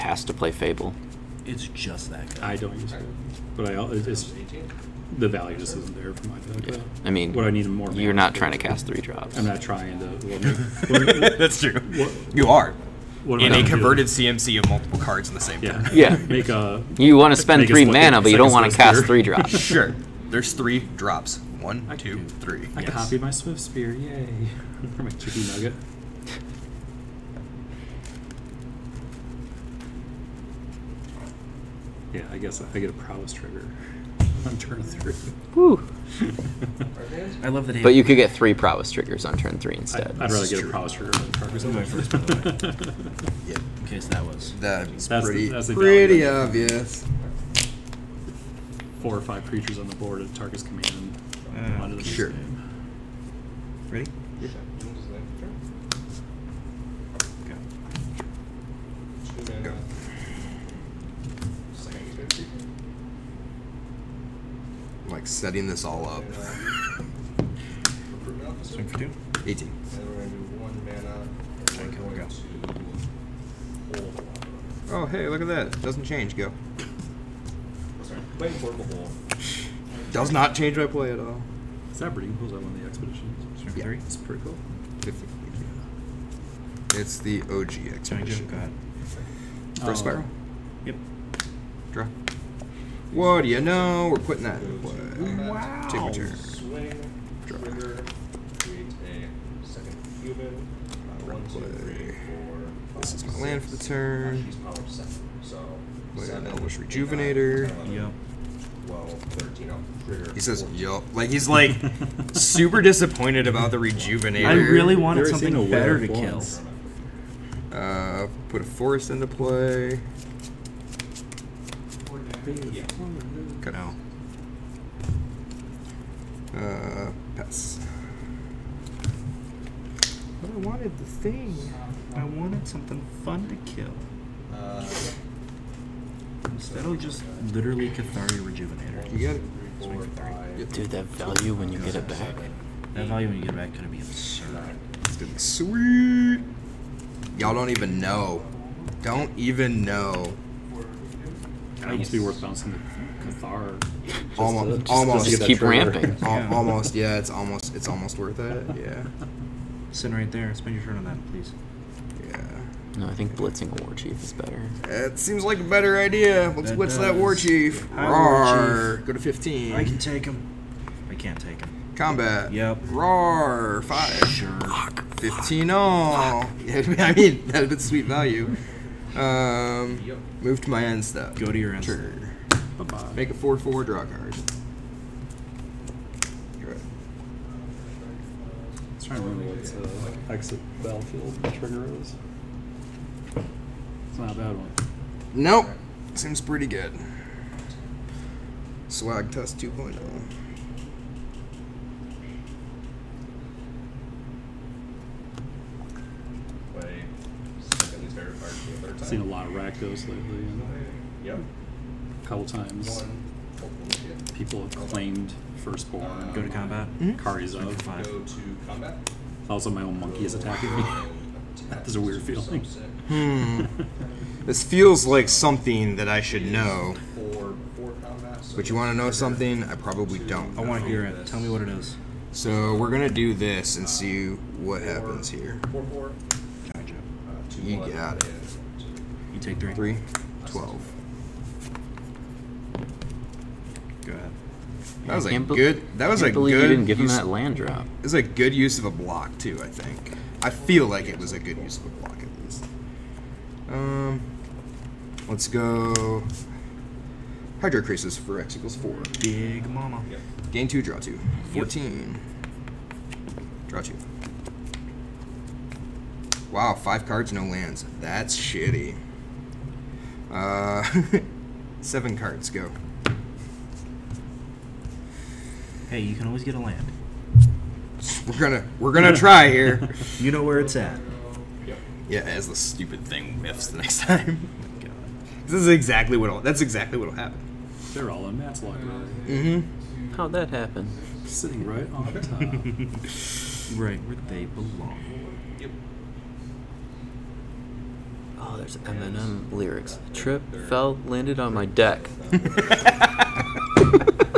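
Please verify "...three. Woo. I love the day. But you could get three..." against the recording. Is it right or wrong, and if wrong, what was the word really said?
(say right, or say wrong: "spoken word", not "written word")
right.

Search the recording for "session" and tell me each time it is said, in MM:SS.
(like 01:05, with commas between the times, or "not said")
not said.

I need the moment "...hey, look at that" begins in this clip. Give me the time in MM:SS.
01:15.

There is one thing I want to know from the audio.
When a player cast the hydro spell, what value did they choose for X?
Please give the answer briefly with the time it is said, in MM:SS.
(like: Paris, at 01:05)
4, at 04:18.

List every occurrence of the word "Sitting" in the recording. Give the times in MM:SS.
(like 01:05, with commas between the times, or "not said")
02:39, 04:51.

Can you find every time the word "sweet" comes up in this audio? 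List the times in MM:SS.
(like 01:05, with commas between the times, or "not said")
02:25, 02:57.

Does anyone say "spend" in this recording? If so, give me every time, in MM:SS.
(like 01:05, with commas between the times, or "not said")
00:17, 02:40.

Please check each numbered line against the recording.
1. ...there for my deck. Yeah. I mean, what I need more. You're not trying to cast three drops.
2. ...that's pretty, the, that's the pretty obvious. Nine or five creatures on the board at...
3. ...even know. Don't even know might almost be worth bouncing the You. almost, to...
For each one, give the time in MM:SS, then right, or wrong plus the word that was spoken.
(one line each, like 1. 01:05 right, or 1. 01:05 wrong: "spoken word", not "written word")
1. 00:05 right
2. 00:45 wrong: "Four", not "Nine"
3. 02:27 wrong: "Cathar", not "You".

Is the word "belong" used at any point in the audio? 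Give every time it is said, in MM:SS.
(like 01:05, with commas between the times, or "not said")
04:54.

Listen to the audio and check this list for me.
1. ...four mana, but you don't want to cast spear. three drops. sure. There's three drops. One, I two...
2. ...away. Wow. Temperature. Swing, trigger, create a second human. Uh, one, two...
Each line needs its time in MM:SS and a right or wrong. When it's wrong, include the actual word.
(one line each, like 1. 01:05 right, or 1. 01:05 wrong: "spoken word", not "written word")
1. 00:17 wrong: "three", not "four"
2. 01:34 right.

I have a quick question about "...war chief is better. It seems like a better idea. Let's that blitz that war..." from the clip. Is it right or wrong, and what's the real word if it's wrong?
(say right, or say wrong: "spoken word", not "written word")
right.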